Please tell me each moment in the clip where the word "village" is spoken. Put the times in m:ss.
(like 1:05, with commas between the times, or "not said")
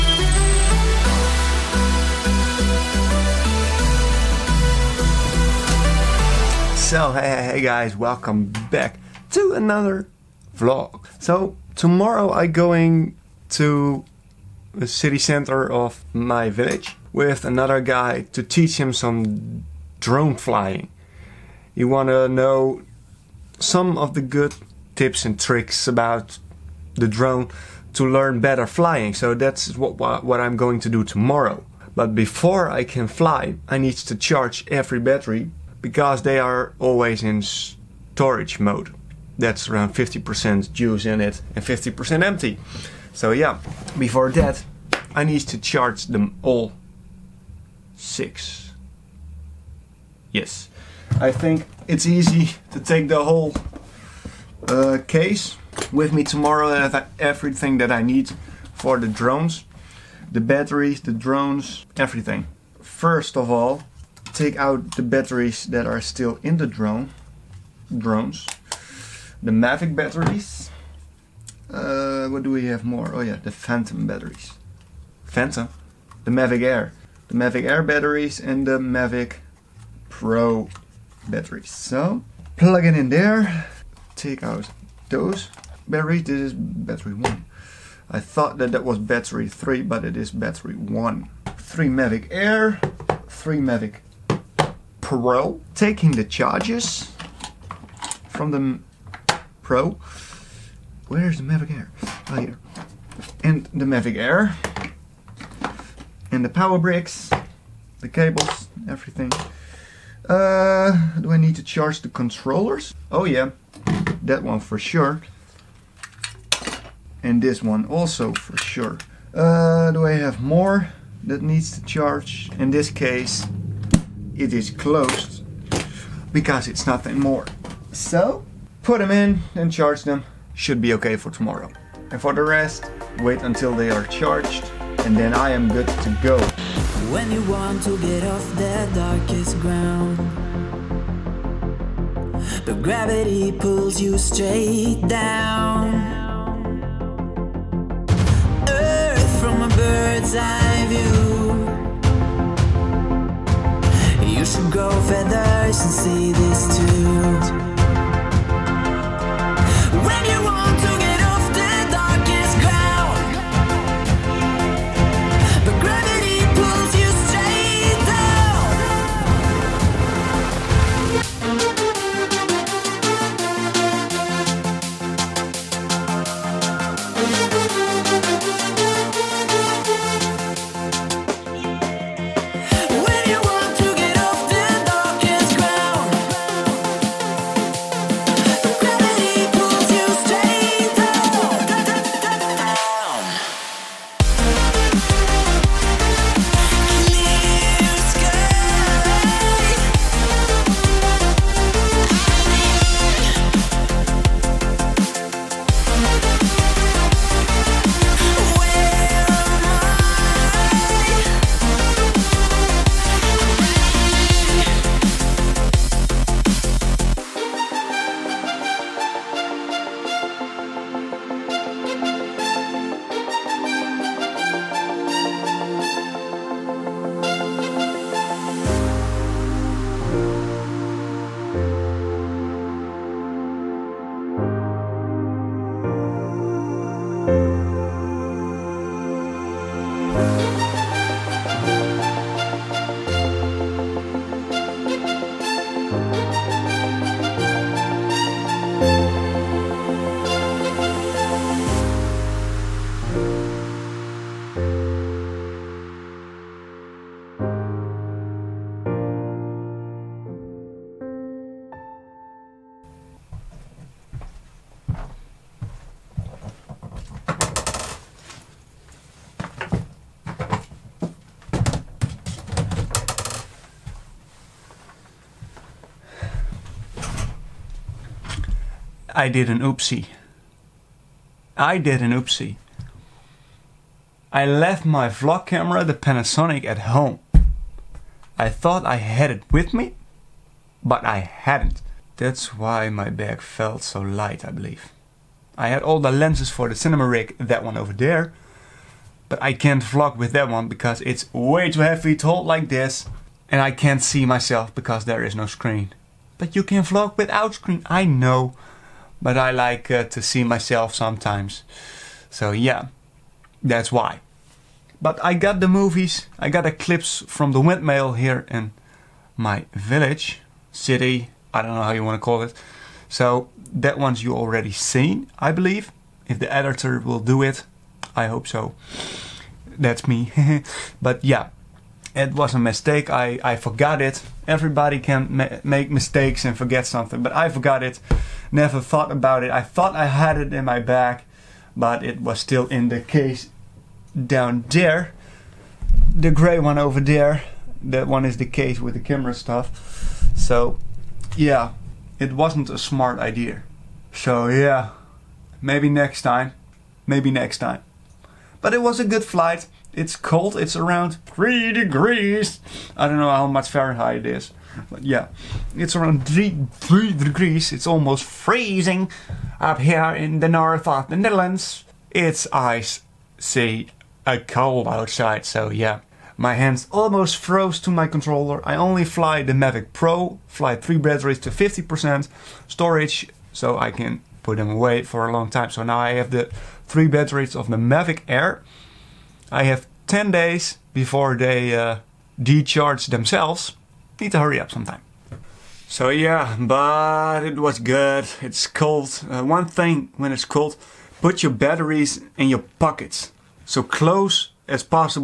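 0:16, 5:19.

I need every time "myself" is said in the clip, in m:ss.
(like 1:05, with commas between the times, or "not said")
5:04, 5:10.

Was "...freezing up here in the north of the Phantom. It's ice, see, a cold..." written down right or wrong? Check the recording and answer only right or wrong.
wrong.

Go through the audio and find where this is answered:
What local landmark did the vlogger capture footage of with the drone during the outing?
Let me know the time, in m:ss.
5:17.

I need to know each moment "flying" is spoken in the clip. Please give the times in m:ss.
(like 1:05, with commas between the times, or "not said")
0:20, 0:28.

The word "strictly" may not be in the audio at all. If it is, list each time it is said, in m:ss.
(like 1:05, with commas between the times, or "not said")
not said.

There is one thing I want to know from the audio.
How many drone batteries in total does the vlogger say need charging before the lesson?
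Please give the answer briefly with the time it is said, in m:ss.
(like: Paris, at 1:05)
6, at 0:46.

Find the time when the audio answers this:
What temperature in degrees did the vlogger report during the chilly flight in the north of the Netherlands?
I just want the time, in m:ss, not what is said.
6:00.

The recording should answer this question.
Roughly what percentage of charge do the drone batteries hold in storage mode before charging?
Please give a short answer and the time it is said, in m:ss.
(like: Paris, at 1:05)
50%, at 0:39.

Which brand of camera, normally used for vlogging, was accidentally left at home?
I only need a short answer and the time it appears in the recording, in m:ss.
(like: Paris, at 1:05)
Panasonic, at 4:45.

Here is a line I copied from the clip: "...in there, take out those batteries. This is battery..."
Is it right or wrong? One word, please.
right.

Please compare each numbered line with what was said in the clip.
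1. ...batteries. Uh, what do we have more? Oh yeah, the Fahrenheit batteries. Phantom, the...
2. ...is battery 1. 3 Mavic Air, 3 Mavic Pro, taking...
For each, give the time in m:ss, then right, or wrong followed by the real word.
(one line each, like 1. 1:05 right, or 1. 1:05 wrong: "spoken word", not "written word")
1. 1:09 wrong: "Phantom", not "Fahrenheit"
2. 1:30 right.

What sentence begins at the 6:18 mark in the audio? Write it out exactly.
I only fly the Mavic Pro, fly three batteries to 50% storage, so I can put them away for a long time.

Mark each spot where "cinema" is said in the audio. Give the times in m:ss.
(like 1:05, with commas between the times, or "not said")
4:56.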